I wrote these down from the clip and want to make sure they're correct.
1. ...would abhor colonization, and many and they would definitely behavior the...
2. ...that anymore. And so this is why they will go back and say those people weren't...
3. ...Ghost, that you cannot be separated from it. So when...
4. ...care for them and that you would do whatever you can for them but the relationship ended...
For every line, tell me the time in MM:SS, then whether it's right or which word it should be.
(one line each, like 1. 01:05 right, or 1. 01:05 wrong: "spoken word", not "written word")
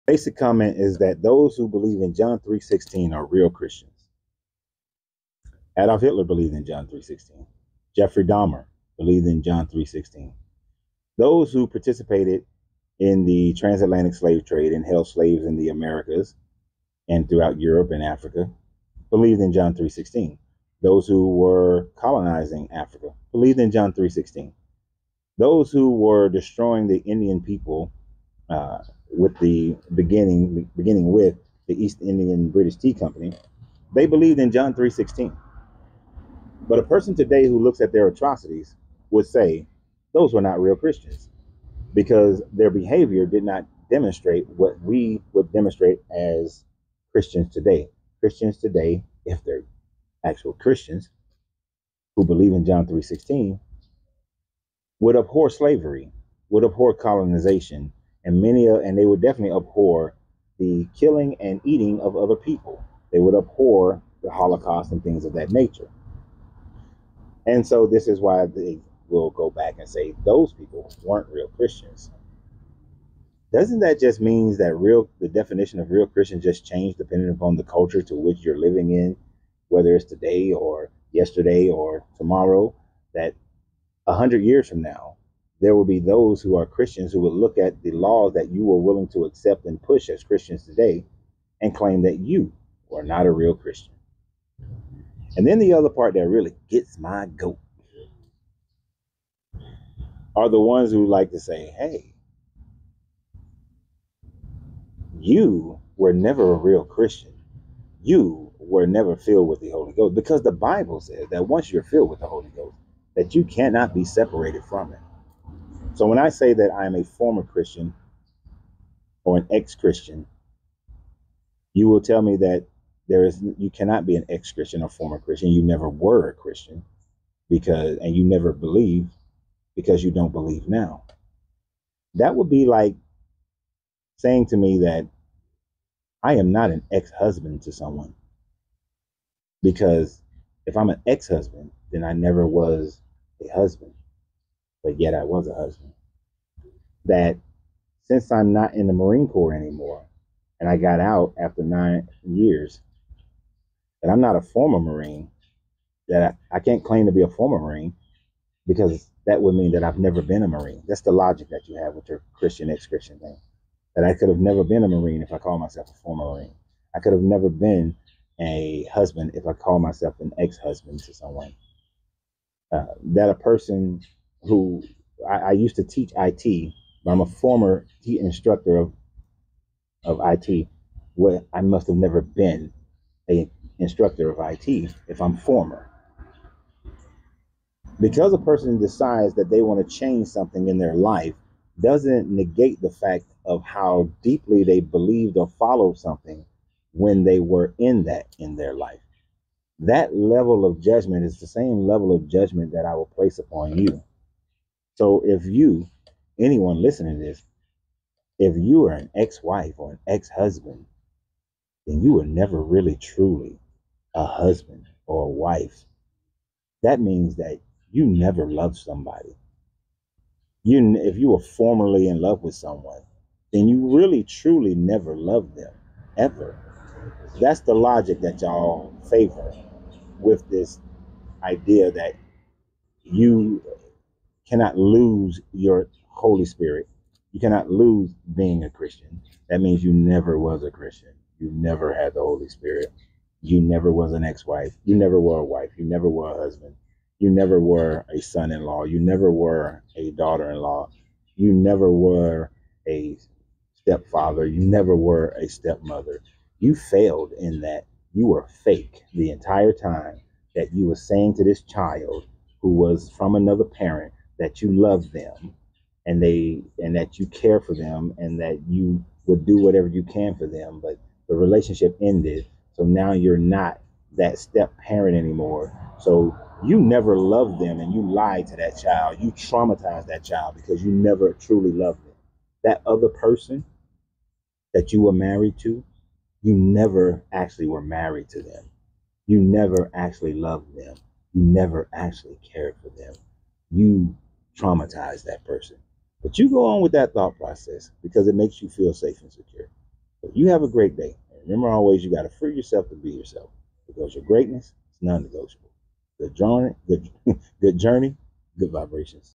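1. 00:56 wrong: "abhor", not "behavior"
2. 01:05 wrong: "nature", not "anymore"
3. 01:52 right
4. 04:27 right.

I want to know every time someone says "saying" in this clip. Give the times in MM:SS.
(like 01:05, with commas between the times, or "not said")
02:14, 04:20.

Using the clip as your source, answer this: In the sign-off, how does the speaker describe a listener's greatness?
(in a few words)
non negotiable.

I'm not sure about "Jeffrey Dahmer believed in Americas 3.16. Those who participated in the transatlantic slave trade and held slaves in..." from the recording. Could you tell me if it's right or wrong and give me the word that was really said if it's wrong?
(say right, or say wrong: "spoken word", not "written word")
wrong: "John", not "Americas".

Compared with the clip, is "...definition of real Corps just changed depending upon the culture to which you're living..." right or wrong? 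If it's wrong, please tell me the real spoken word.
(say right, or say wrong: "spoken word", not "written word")
wrong: "Christian", not "Corps".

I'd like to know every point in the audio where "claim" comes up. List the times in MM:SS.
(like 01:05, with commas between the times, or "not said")
01:31, 02:36.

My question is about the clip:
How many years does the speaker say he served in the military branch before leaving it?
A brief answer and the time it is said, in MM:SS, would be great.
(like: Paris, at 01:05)
9, at 02:31.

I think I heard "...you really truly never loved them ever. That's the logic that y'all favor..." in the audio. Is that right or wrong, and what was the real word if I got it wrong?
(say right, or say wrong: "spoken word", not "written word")
right.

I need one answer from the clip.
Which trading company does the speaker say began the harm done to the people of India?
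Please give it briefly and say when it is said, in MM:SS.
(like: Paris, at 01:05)
East Indian British Tea Company, at 00:31.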